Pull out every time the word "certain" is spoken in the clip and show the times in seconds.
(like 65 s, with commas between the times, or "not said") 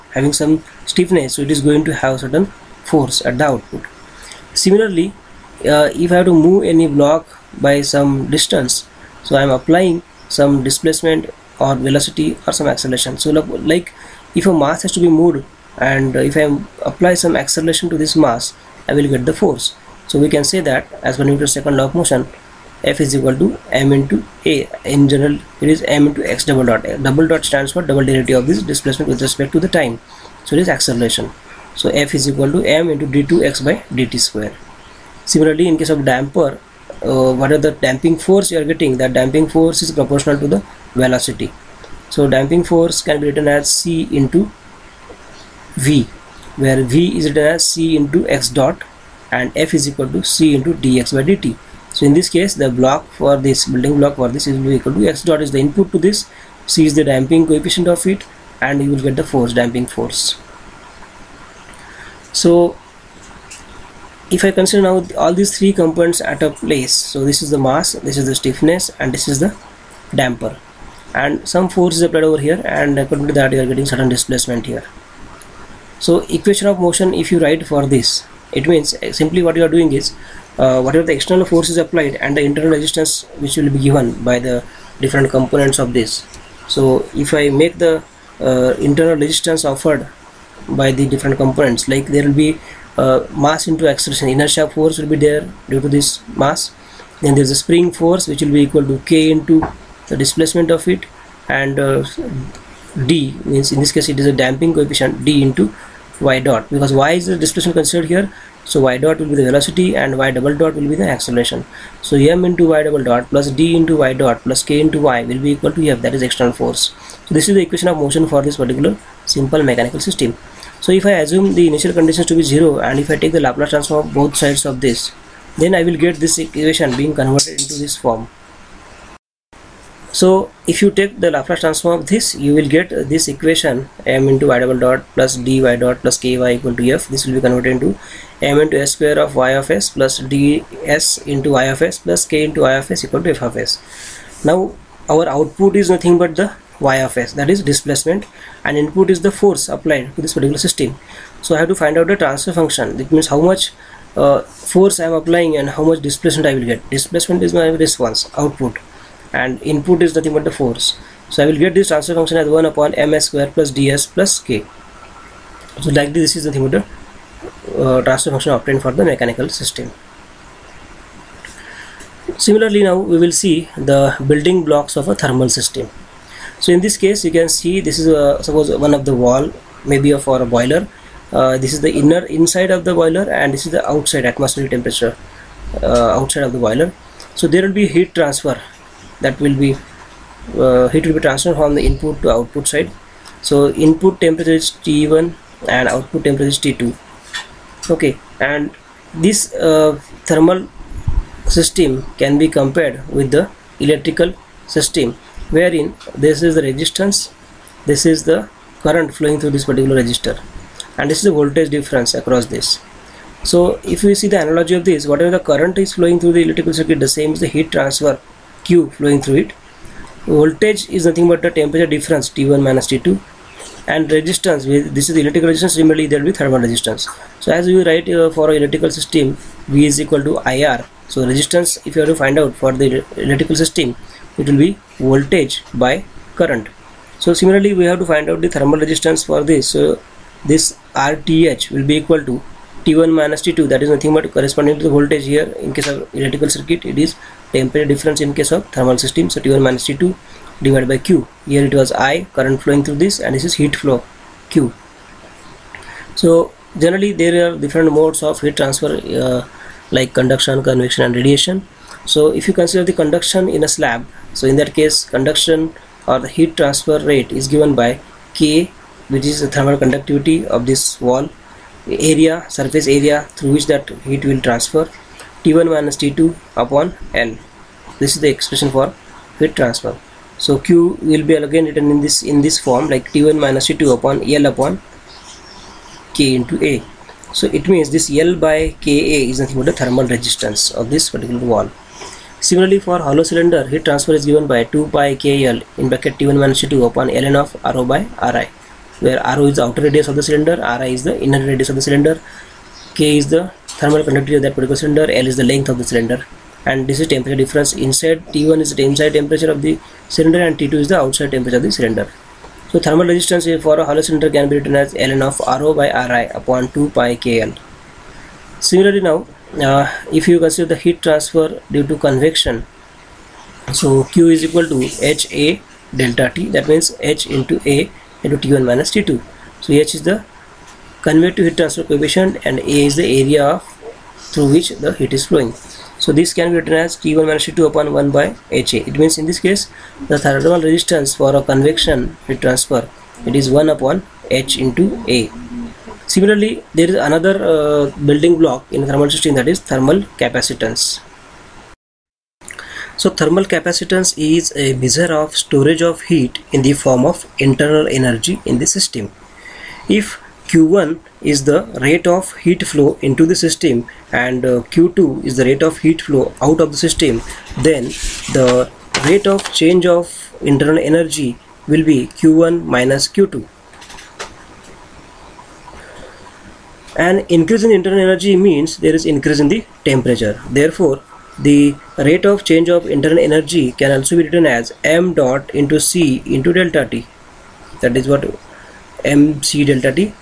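2 s, 73 s.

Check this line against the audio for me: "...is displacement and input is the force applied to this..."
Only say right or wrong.
right.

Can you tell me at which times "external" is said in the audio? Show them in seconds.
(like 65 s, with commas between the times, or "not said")
81 s, 116 s.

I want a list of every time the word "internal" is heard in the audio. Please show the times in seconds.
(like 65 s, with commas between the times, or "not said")
82 s, 88 s, 357 s, 370 s, 377 s, 382 s.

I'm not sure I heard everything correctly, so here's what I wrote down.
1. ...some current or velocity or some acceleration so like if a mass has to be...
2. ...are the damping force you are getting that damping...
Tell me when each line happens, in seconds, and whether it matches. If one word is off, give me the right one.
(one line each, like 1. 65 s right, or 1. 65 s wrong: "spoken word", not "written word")
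1. 10 s wrong: "displacement", not "current"
2. 37 s right.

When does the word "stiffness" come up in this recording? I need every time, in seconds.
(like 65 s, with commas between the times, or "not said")
0 s, 68 s.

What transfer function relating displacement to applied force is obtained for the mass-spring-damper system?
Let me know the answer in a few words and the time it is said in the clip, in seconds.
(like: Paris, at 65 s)
1/(ms^2 + ds + k), at 162 s.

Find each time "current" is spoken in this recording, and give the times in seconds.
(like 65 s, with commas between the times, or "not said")
208 s, 215 s, 236 s, 252 s.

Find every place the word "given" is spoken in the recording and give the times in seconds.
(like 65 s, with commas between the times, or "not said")
83 s, 267 s, 294 s.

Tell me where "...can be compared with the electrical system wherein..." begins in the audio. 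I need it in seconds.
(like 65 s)
202 s.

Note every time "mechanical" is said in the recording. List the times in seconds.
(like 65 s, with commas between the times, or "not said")
119 s, 169 s.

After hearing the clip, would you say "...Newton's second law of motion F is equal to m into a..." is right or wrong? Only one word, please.
right.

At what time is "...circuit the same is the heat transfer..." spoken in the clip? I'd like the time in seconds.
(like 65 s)
216 s.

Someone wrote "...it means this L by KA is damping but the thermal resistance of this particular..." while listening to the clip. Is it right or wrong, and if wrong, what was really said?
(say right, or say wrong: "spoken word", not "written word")
wrong: "nothing", not "damping".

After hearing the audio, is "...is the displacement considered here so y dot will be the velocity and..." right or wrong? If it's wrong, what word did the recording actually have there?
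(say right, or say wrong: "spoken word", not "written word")
right.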